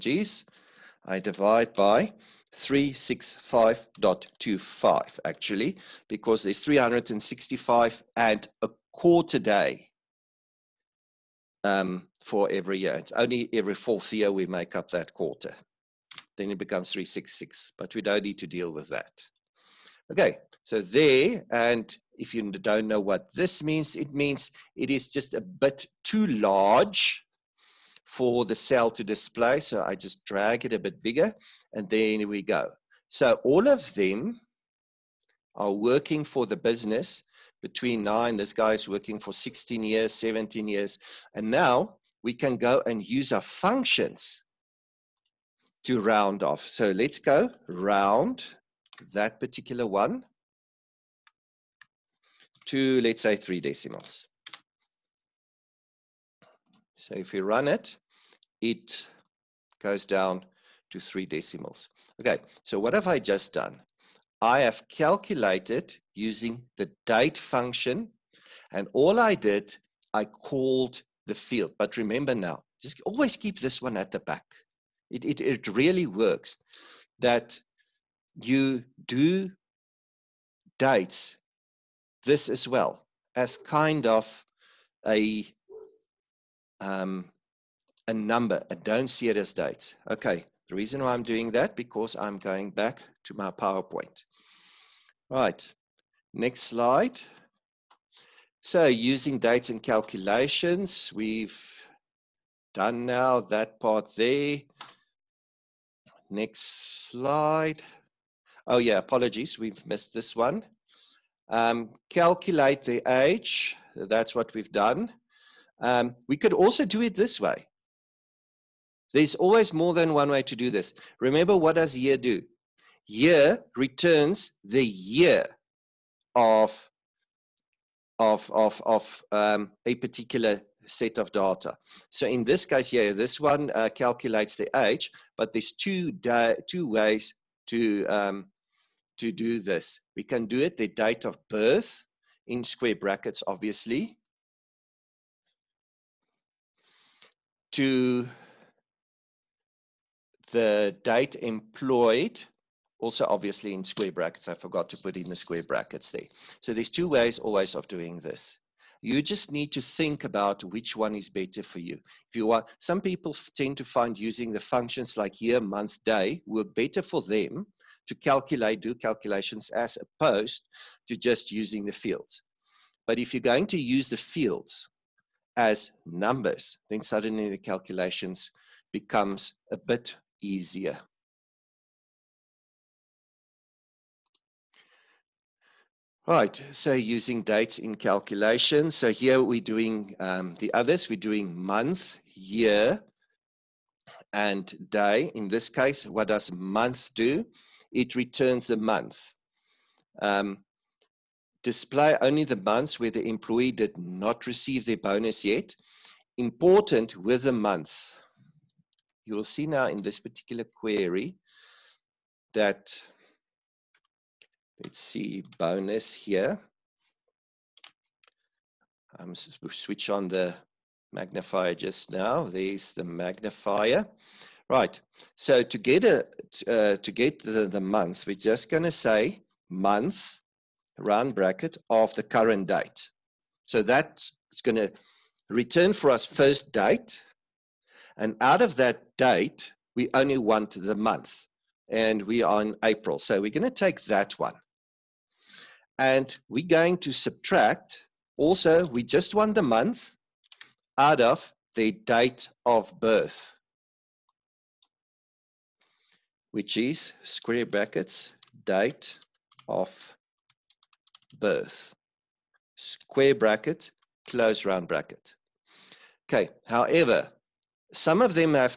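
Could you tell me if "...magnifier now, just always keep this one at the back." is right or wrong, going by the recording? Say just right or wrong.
wrong.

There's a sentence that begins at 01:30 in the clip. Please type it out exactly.
Okay, the reason why I'm doing that because I'm going back to my PowerPoint.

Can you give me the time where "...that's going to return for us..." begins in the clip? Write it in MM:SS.
03:53.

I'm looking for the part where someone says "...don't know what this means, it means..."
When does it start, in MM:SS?
00:22.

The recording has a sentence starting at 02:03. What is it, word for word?
Year returns the year of, of, of, of um, a particular set of data.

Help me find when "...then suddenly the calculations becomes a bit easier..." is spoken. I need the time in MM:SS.
02:56.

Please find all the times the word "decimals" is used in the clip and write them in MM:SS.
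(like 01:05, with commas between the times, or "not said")
00:53, 01:01.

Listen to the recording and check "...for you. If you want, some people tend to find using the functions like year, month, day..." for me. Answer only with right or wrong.
right.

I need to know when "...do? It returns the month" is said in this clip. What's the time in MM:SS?
03:17.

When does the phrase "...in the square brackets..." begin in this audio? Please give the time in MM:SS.
02:35.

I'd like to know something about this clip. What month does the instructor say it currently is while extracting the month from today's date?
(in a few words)
April.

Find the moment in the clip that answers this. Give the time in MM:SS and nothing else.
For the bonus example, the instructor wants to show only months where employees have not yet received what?
03:24.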